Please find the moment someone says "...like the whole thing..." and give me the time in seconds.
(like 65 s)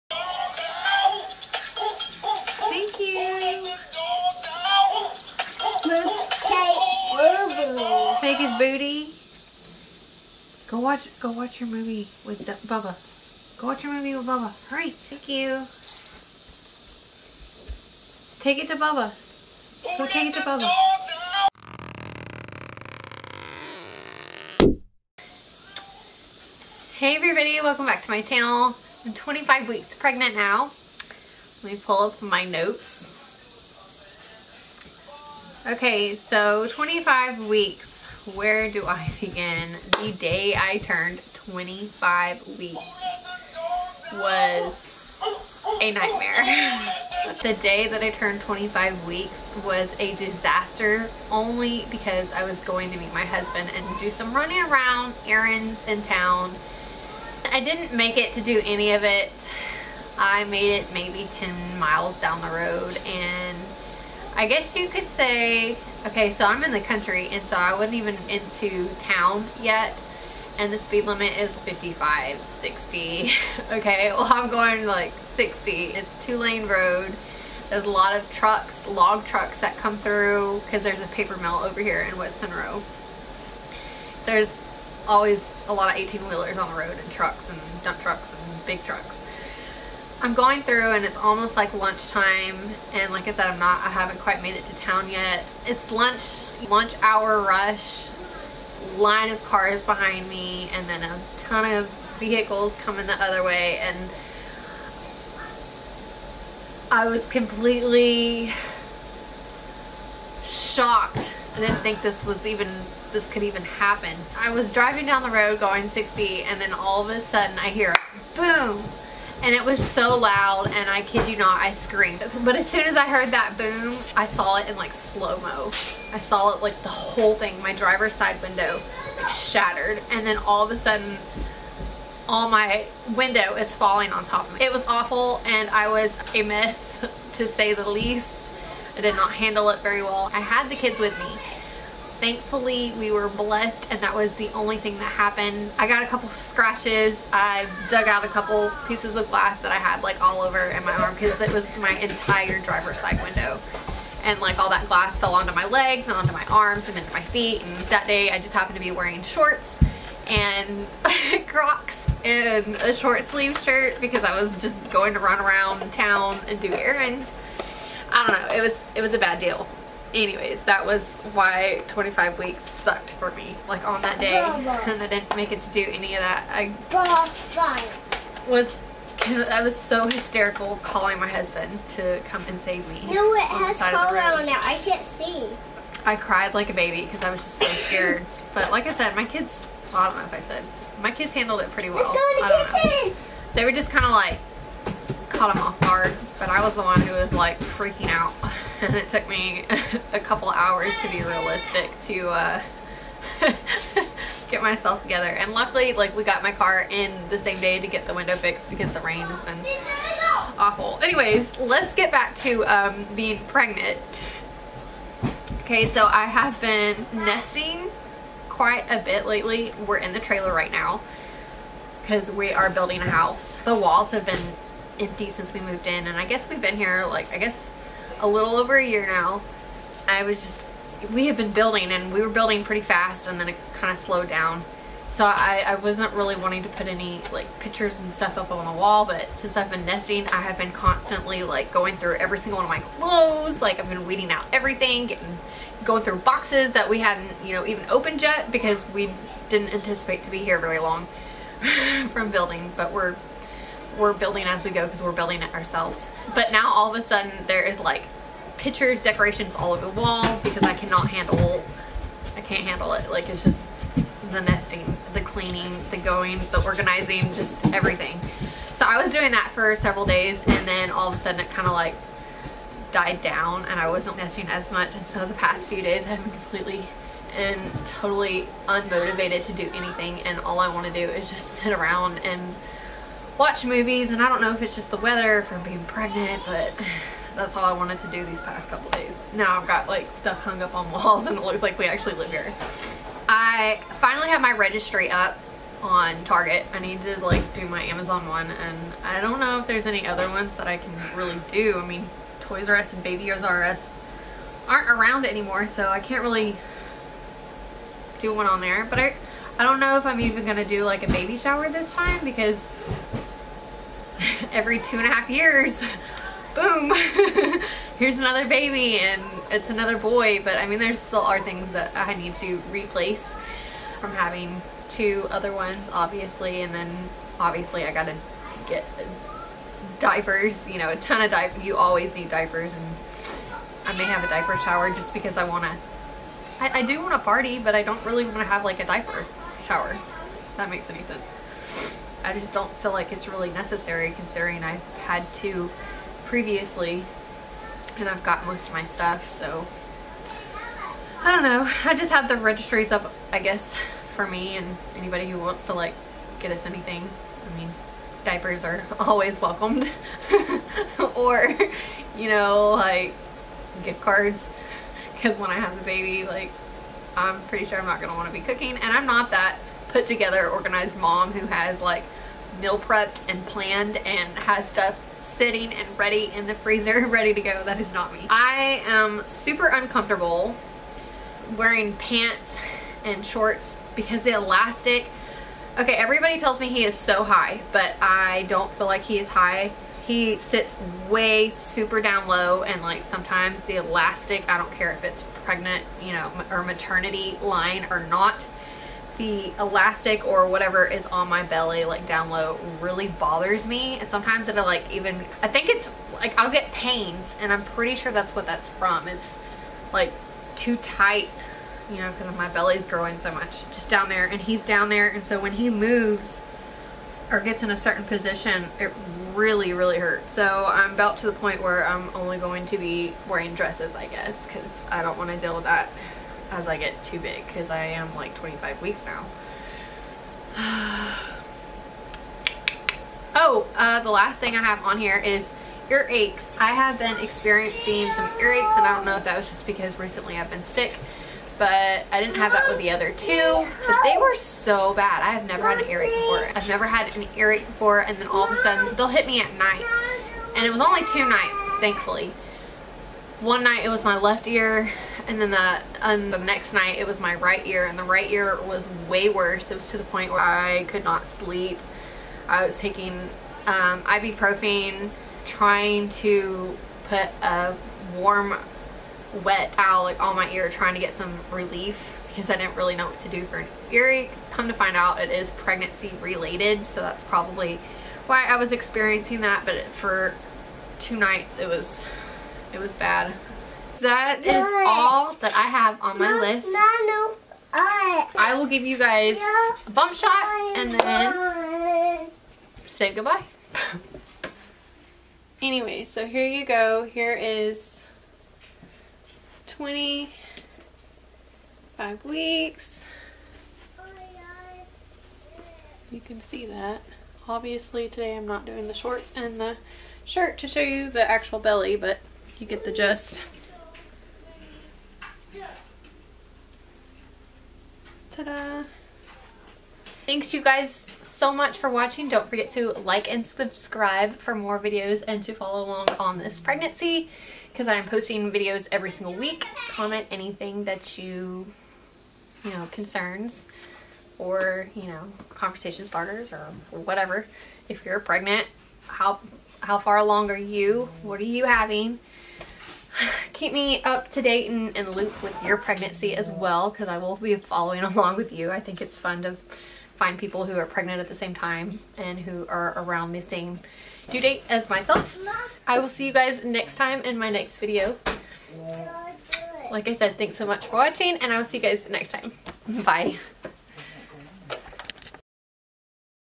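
126 s.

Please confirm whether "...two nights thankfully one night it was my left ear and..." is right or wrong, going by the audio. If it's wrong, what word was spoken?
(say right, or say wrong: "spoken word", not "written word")
right.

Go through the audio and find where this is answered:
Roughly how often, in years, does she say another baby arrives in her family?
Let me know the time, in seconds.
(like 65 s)
314 s.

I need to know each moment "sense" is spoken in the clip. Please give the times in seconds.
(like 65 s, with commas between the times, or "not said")
341 s.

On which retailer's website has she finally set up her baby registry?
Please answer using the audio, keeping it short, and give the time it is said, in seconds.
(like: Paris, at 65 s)
Target, at 296 s.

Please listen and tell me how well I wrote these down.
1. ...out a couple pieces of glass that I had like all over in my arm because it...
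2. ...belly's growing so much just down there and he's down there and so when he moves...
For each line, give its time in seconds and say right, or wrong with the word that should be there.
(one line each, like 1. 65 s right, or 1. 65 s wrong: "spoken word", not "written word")
1. 148 s right
2. 412 s right.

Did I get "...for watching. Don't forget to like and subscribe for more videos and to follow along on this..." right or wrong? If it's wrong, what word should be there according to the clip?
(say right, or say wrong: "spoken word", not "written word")
right.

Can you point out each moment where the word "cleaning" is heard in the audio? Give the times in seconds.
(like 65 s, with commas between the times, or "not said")
265 s.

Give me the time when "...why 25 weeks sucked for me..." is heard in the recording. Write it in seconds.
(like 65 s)
171 s.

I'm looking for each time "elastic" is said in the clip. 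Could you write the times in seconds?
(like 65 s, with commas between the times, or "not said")
384 s, 393 s, 399 s.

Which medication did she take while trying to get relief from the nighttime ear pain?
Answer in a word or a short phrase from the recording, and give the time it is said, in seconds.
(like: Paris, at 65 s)
Ibuprofen, at 464 s.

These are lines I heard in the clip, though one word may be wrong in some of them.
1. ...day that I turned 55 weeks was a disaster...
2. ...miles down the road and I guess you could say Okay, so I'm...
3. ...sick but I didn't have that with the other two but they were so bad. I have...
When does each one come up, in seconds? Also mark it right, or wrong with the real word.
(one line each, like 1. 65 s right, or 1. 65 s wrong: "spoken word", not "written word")
1. 47 s wrong: "25", not "55"
2. 61 s right
3. 440 s right.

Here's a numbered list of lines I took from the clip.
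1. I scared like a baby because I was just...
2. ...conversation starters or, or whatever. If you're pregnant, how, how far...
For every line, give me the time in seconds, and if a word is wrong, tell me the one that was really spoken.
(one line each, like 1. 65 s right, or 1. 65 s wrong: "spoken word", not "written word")
1. 186 s wrong: "cried", not "scared"
2. 535 s right.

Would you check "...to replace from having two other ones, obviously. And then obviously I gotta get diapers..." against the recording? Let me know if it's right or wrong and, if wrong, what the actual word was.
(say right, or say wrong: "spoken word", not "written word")
right.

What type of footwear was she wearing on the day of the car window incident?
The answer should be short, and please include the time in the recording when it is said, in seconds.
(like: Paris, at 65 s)
Crocs, at 161 s.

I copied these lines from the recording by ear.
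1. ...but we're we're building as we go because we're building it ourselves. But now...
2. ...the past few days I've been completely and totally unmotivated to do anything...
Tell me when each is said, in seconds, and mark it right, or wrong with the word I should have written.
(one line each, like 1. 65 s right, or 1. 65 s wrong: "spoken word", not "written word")
1. 252 s right
2. 275 s right.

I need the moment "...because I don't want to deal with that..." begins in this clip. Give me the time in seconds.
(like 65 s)
424 s.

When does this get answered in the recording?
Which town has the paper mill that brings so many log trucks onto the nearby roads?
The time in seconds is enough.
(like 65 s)
82 s.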